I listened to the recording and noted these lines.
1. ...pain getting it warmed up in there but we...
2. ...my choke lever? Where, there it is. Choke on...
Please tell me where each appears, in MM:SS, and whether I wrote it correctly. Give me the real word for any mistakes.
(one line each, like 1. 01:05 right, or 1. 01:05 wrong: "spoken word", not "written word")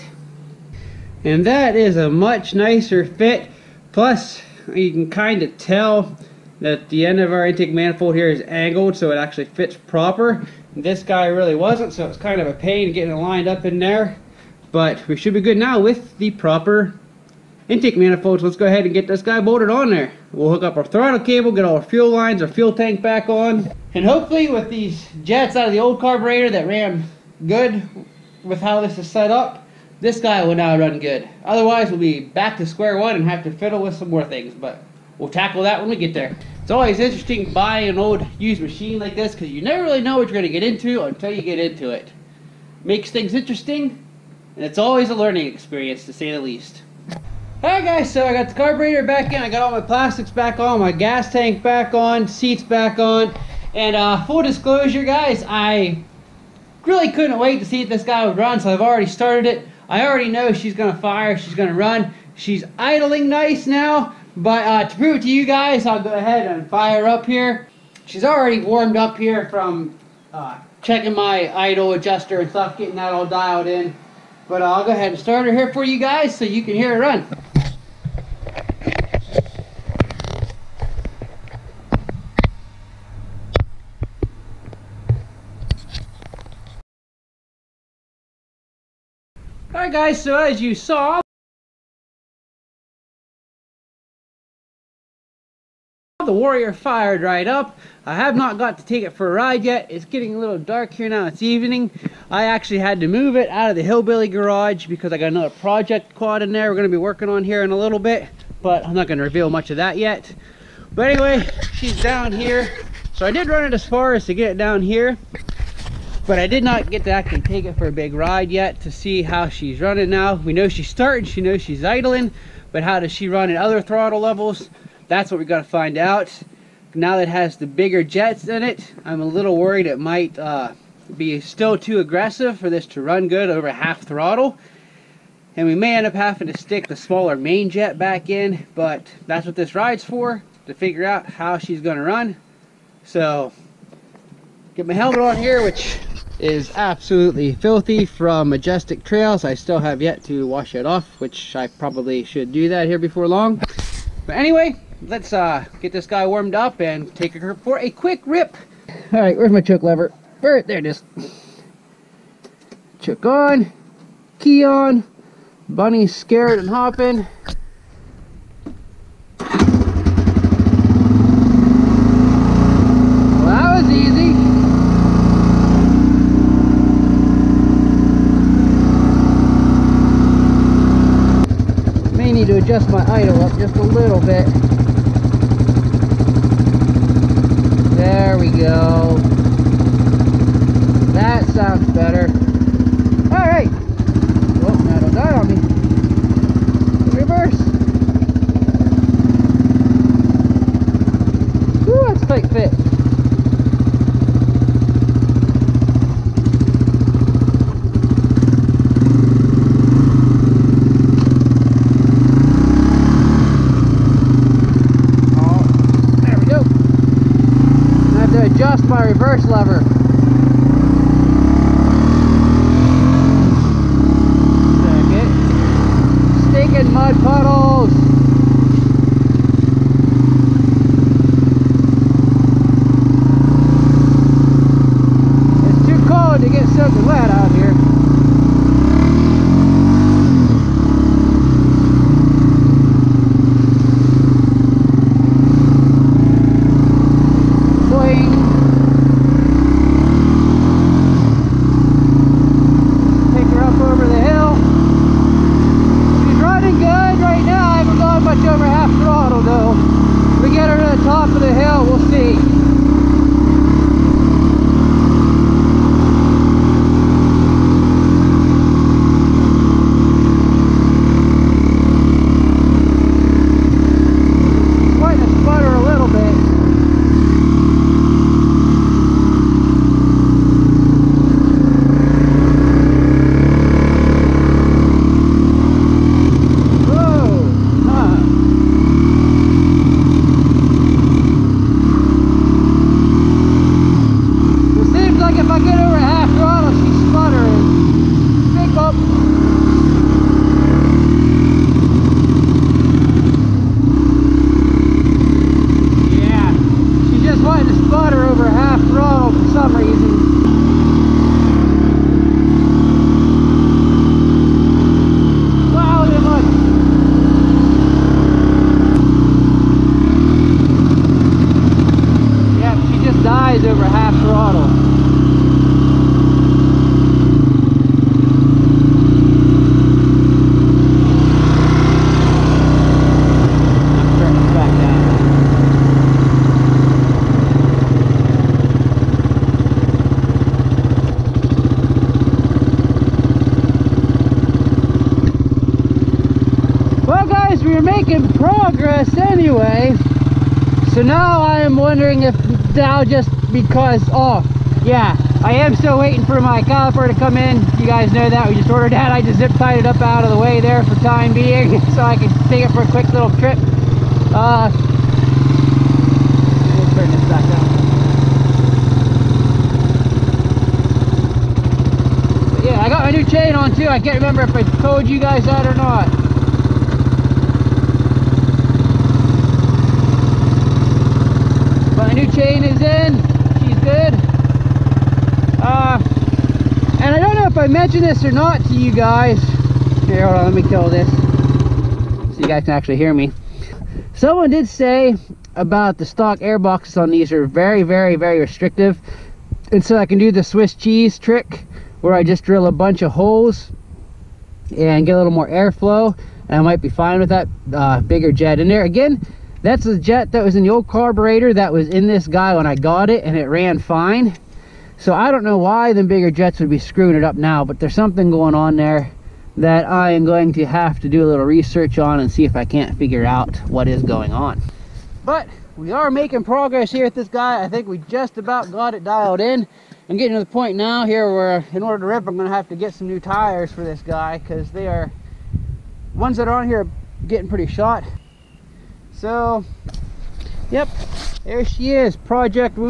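1. 00:12 wrong: "lined", not "warmed"
2. 02:39 right.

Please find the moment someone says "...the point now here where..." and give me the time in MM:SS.
07:10.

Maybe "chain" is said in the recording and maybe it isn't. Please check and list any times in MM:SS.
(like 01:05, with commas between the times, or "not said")
06:13, 06:22.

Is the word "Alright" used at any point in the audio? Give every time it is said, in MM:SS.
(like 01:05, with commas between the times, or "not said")
00:47, 01:29.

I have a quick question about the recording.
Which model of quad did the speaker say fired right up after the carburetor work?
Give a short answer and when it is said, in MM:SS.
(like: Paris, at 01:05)
Warrior, at 01:36.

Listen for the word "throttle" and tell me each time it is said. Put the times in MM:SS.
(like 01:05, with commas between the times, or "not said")
00:20, 02:03, 02:14.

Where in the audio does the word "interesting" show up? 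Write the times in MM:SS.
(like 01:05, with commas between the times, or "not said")
00:36, 00:43.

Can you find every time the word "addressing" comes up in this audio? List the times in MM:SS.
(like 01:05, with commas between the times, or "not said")
not said.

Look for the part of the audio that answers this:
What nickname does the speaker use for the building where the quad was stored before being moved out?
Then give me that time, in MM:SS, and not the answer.
01:43.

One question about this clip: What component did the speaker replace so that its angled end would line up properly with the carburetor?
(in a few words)
Intake manifold.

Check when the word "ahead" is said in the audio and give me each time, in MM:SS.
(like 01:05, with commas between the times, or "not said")
00:18, 01:06, 01:14.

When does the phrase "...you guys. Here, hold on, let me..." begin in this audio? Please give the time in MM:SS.
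06:28.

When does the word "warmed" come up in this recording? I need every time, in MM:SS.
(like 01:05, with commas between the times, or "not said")
01:08, 02:36.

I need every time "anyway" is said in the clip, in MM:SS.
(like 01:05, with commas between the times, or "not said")
01:51, 02:34.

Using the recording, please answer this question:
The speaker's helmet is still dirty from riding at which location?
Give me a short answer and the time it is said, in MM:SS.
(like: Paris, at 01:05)
Majestic Trails, at 02:28.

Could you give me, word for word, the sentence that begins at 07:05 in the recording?
But we are making progress here with this guy.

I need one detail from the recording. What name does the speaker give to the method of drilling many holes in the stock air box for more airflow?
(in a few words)
Swiss cheese trick.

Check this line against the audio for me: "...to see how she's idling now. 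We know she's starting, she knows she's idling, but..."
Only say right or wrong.
wrong.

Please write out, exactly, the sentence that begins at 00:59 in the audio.
I already know she's going to fire.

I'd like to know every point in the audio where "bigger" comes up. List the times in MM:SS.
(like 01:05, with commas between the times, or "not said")
02:07, 06:47, 06:56.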